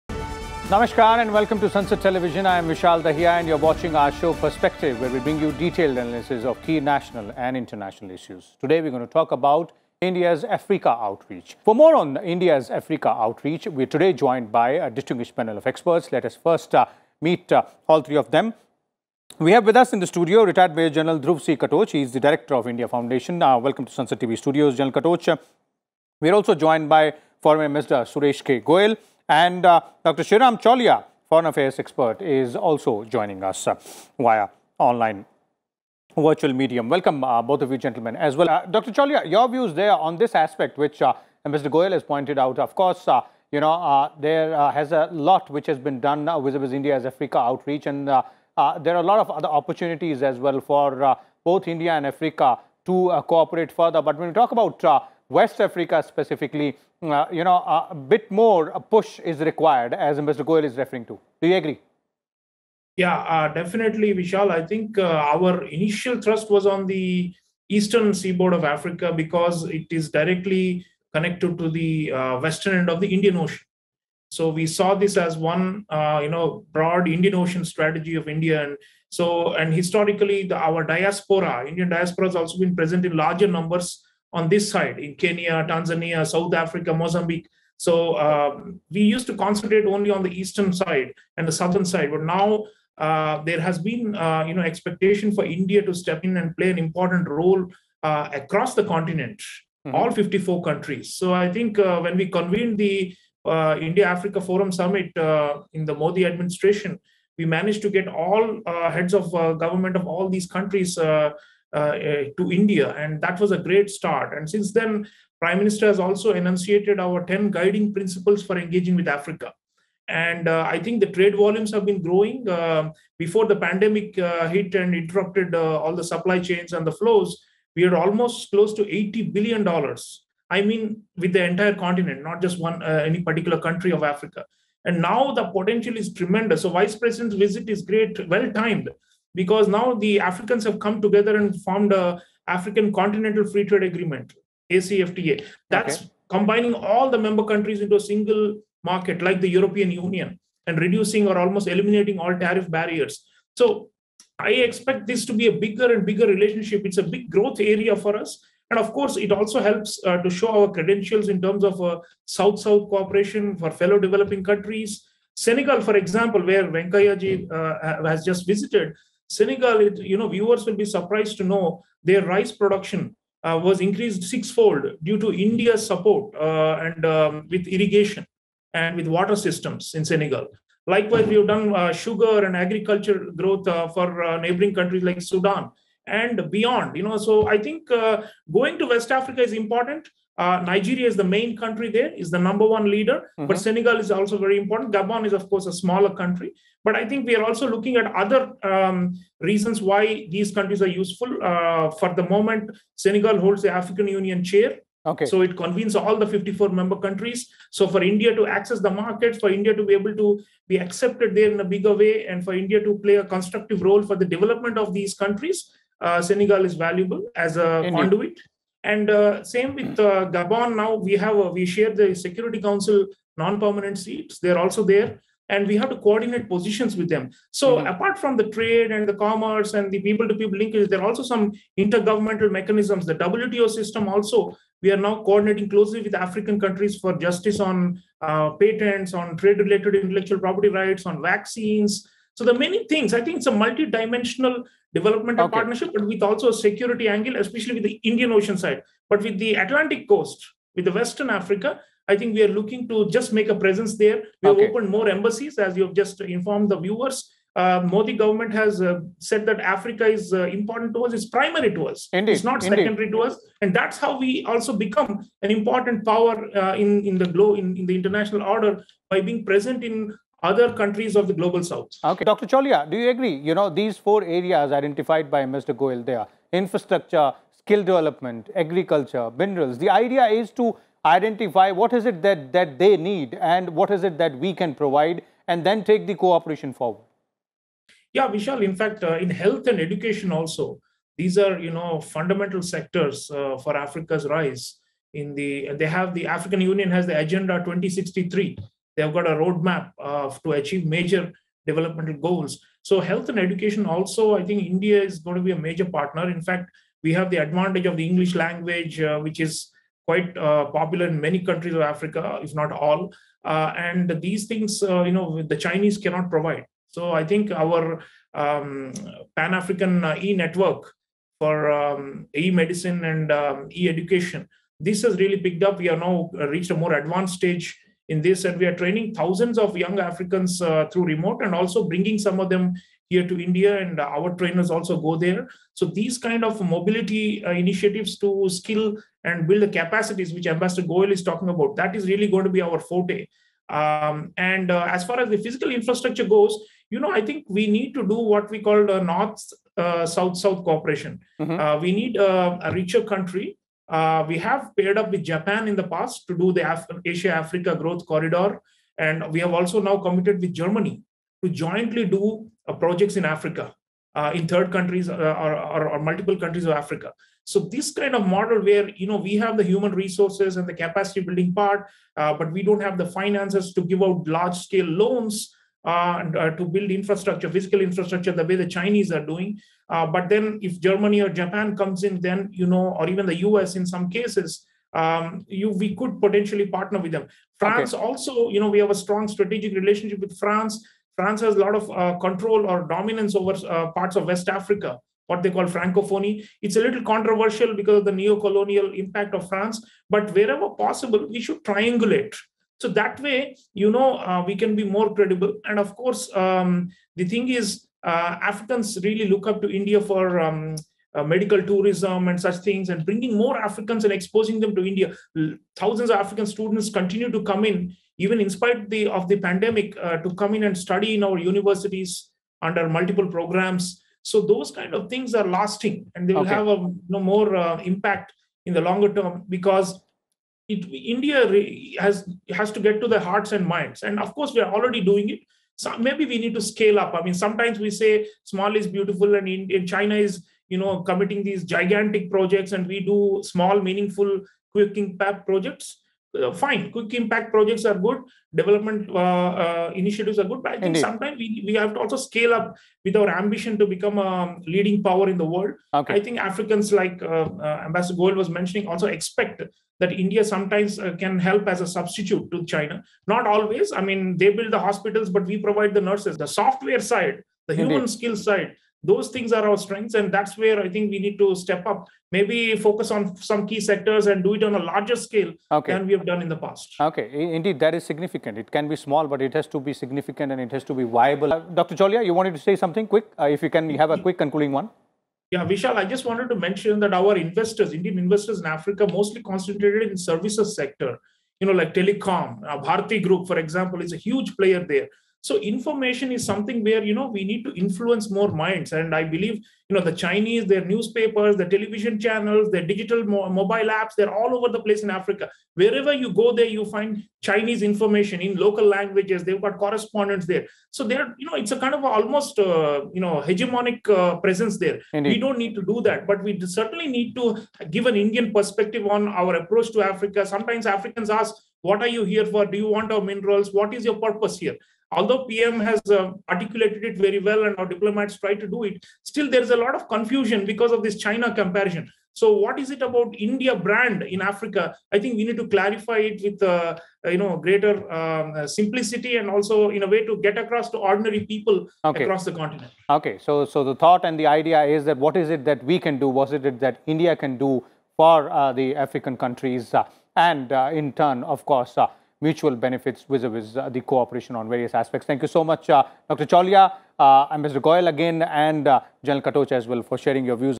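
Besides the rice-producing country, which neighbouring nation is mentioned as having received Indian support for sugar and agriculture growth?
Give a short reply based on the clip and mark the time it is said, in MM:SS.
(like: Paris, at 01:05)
Sudan, at 03:05.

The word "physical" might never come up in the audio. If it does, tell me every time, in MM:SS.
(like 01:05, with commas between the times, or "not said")
05:45, 06:17.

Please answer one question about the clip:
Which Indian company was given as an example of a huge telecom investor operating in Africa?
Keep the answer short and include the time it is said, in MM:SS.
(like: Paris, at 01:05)
Bharti Group, at 08:12.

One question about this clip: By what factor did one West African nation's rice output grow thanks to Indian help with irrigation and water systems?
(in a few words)
Sixfold.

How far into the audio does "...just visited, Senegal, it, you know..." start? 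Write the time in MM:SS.
02:48.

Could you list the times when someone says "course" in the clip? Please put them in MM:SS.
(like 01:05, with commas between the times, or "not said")
00:42, 02:38, 03:15, 06:45, 07:14, 09:11.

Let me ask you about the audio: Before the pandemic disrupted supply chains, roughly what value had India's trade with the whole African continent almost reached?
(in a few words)
$80 billion.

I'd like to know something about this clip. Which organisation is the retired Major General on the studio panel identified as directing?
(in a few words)
India Foundation.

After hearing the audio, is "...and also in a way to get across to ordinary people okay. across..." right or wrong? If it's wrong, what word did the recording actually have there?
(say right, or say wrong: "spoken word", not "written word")
right.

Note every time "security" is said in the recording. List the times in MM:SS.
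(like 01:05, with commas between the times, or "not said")
03:42, 04:06.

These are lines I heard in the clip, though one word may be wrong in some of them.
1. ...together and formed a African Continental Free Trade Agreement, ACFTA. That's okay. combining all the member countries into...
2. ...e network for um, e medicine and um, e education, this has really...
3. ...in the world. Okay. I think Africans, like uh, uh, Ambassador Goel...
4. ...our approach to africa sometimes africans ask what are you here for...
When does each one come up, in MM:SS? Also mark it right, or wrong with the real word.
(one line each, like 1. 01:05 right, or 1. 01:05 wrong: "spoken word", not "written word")
1. 02:21 right
2. 05:20 right
3. 07:35 right
4. 08:39 right.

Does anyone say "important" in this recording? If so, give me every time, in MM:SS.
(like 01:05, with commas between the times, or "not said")
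01:36, 03:09, 03:14, 04:20, 04:25.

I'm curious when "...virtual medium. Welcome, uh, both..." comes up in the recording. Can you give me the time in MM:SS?
00:36.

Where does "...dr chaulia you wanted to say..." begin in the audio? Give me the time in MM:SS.
08:01.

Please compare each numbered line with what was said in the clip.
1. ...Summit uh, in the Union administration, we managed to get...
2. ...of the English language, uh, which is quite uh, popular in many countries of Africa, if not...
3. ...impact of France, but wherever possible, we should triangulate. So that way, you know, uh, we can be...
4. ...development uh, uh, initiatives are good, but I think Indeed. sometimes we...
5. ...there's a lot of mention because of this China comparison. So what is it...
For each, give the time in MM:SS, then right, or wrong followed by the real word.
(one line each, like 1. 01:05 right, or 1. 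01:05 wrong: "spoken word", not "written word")
1. 01:44 wrong: "Modi", not "Union"
2. 05:07 right
3. 06:38 right
4. 07:28 right
5. 08:49 wrong: "confusion", not "mention".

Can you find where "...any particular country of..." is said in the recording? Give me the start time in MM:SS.
02:13.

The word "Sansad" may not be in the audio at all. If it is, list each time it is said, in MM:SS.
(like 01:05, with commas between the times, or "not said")
00:01, 00:23.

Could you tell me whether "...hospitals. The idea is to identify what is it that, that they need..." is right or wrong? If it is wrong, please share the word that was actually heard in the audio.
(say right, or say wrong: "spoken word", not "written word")
wrong: "minerals", not "hospitals".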